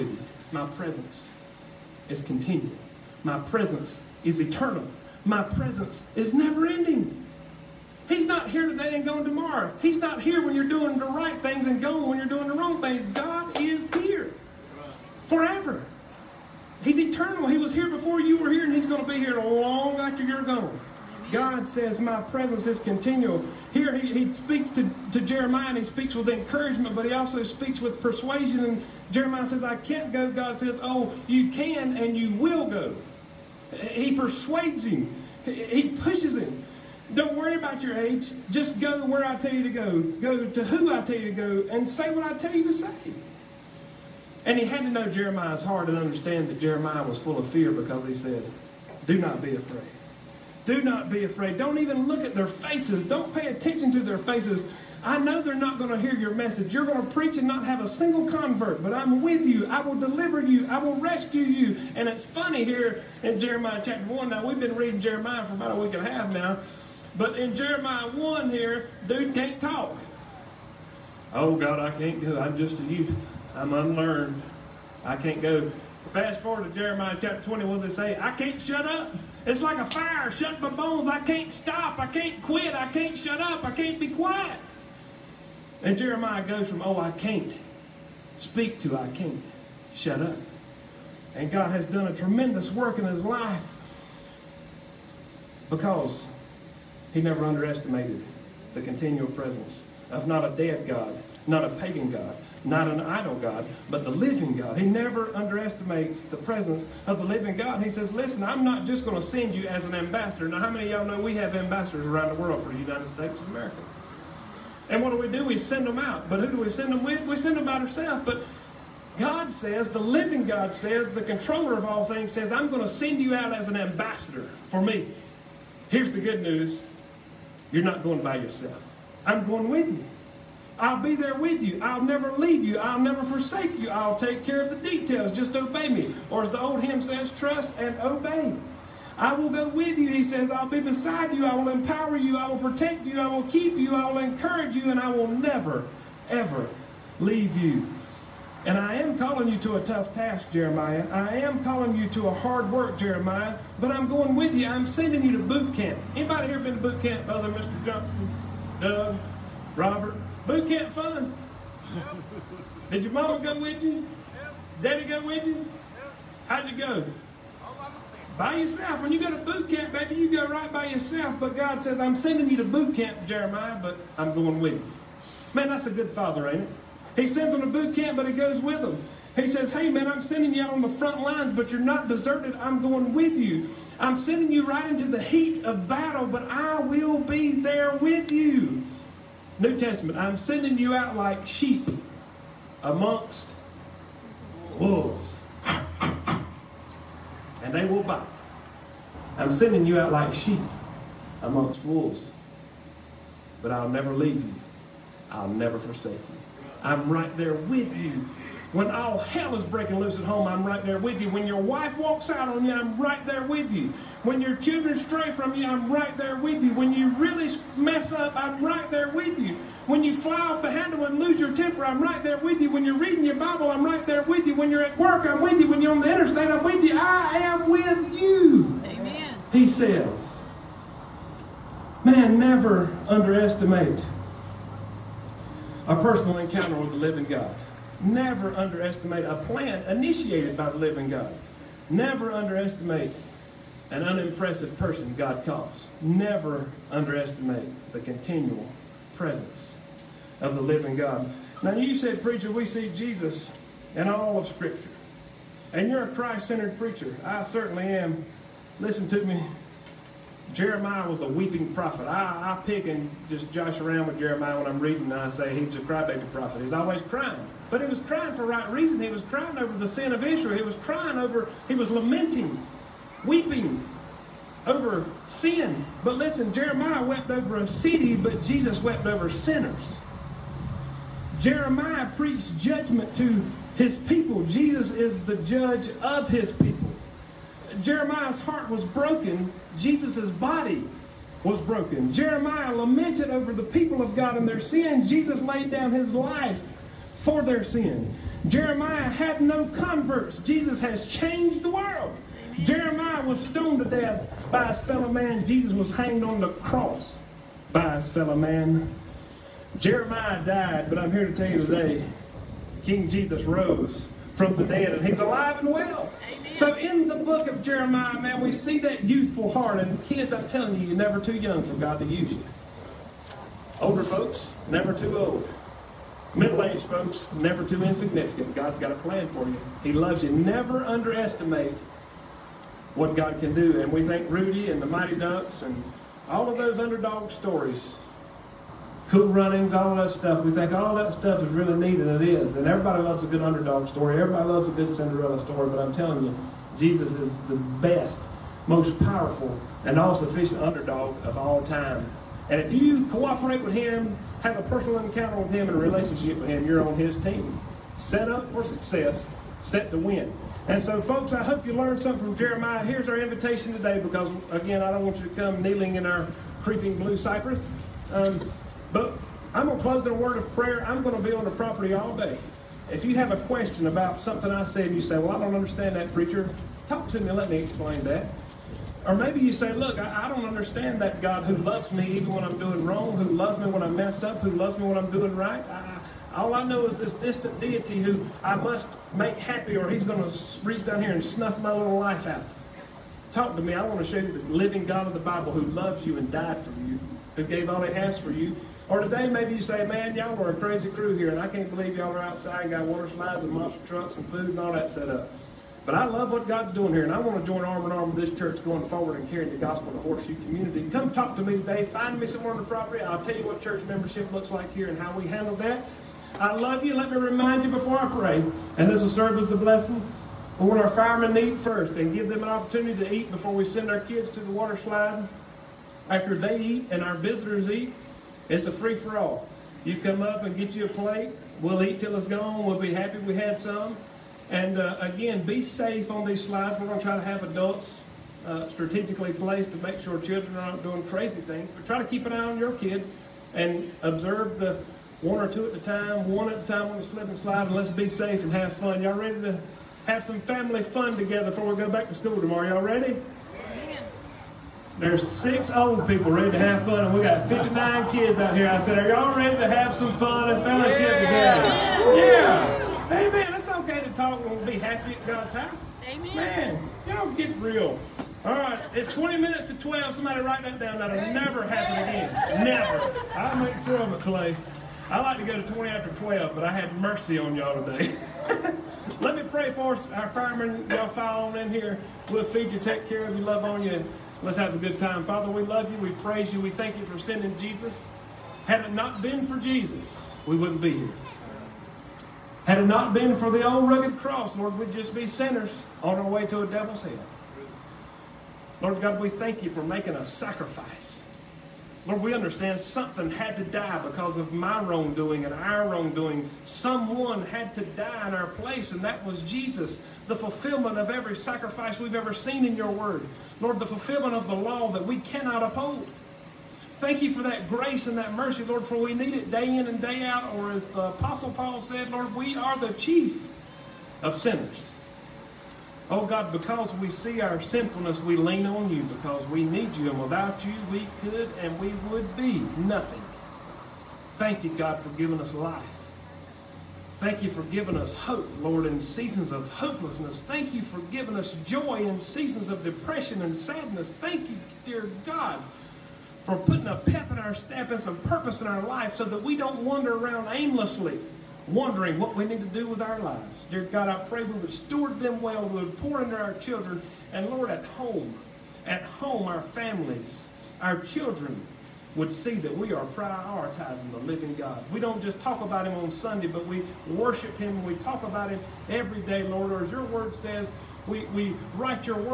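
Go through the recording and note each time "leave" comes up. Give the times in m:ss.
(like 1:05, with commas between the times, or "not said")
2:12, 2:27, 3:24.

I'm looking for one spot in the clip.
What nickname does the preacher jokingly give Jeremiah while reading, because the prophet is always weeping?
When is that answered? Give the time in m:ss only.
4:25.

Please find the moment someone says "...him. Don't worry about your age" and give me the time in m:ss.
0:36.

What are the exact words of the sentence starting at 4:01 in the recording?
Never underestimate an unimpressive person God calls.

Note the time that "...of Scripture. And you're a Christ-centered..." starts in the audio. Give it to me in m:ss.
4:14.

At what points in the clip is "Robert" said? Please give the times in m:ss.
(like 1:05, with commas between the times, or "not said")
2:39.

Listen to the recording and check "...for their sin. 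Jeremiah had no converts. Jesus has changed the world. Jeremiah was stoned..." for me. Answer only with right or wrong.
right.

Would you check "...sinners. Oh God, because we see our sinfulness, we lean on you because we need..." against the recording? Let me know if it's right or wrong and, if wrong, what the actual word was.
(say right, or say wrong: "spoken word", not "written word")
right.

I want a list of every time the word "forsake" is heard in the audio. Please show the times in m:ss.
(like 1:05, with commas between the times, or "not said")
2:13, 3:25.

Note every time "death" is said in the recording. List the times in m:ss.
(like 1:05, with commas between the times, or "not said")
5:03.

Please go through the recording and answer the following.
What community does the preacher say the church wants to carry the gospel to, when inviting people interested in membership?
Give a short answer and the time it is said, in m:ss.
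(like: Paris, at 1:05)
Horseshoe community, at 6:49.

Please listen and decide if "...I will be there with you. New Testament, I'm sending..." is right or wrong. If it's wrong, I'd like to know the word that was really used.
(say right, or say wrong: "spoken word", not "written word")
right.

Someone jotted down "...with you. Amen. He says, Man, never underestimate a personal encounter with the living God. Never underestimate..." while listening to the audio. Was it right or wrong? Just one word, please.
right.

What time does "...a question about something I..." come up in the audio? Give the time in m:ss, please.
6:13.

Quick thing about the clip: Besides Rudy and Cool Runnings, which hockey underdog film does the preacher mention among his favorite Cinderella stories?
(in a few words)
The Mighty Ducks.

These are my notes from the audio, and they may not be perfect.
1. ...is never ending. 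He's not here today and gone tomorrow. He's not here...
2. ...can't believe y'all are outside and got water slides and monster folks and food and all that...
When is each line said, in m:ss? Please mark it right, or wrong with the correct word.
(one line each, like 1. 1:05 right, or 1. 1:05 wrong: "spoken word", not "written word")
1. 0:06 right
2. 6:41 wrong: "trucks", not "folks".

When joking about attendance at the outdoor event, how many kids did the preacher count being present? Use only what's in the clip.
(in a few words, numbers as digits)
59.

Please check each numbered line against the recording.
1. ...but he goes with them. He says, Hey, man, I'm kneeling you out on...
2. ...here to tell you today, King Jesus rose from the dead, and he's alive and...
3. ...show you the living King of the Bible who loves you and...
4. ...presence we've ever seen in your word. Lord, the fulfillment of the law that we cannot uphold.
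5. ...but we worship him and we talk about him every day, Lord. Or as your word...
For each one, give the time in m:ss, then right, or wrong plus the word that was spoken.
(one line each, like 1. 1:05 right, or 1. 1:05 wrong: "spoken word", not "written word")
1. 2:58 wrong: "sending", not "kneeling"
2. 5:11 right
3. 6:34 wrong: "God", not "King"
4. 8:31 wrong: "sacrifice", not "presence"
5. 9:26 right.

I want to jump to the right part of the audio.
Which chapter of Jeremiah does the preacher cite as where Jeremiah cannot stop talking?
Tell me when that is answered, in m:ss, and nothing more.
1:16.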